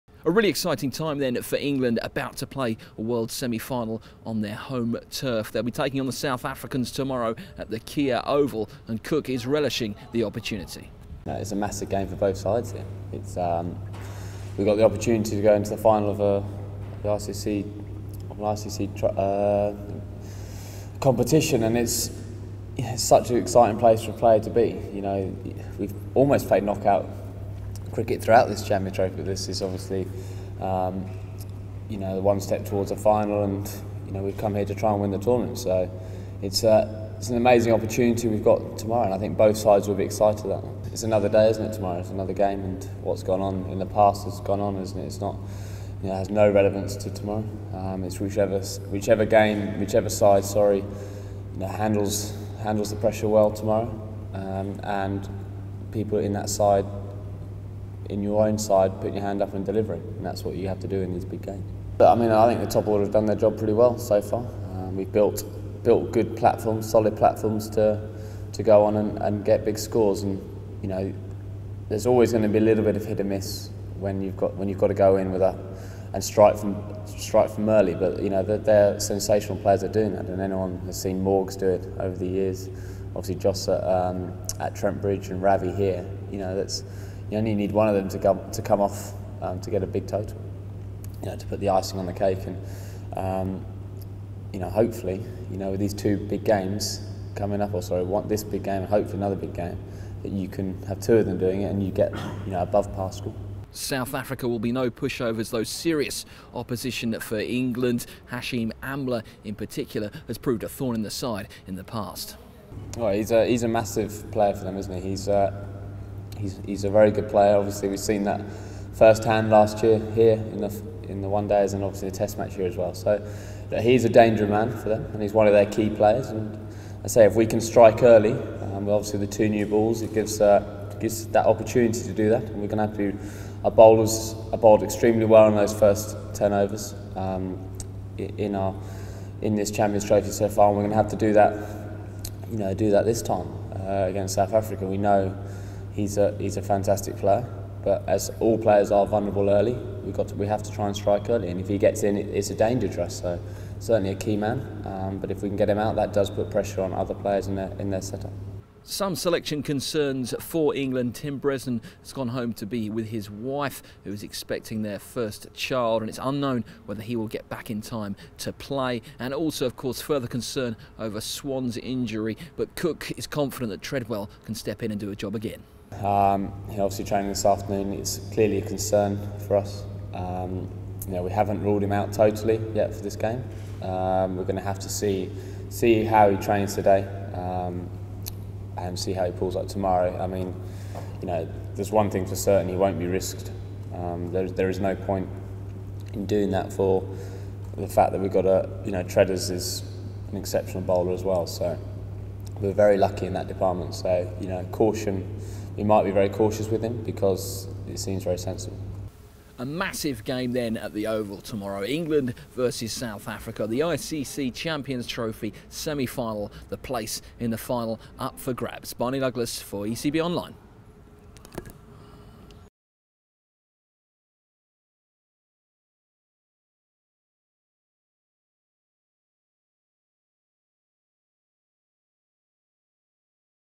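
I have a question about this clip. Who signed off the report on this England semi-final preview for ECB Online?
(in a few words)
Barney Douglas.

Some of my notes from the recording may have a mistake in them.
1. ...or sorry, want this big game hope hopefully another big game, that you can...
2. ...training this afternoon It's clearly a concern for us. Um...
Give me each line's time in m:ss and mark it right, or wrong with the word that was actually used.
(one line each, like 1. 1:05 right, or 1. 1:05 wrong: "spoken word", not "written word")
1. 1:37 right
2. 2:57 right.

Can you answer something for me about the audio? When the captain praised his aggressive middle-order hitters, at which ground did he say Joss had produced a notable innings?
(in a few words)
Trent Bridge.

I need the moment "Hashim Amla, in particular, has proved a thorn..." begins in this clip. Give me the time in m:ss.
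1:48.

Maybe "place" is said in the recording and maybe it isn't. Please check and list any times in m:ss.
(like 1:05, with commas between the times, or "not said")
0:23, 3:36.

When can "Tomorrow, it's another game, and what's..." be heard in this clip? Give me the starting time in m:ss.
0:41.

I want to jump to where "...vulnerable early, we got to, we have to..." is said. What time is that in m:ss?
2:29.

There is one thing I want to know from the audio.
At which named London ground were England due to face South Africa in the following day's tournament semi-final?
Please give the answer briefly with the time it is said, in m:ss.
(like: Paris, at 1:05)
Kia Oval, at 0:07.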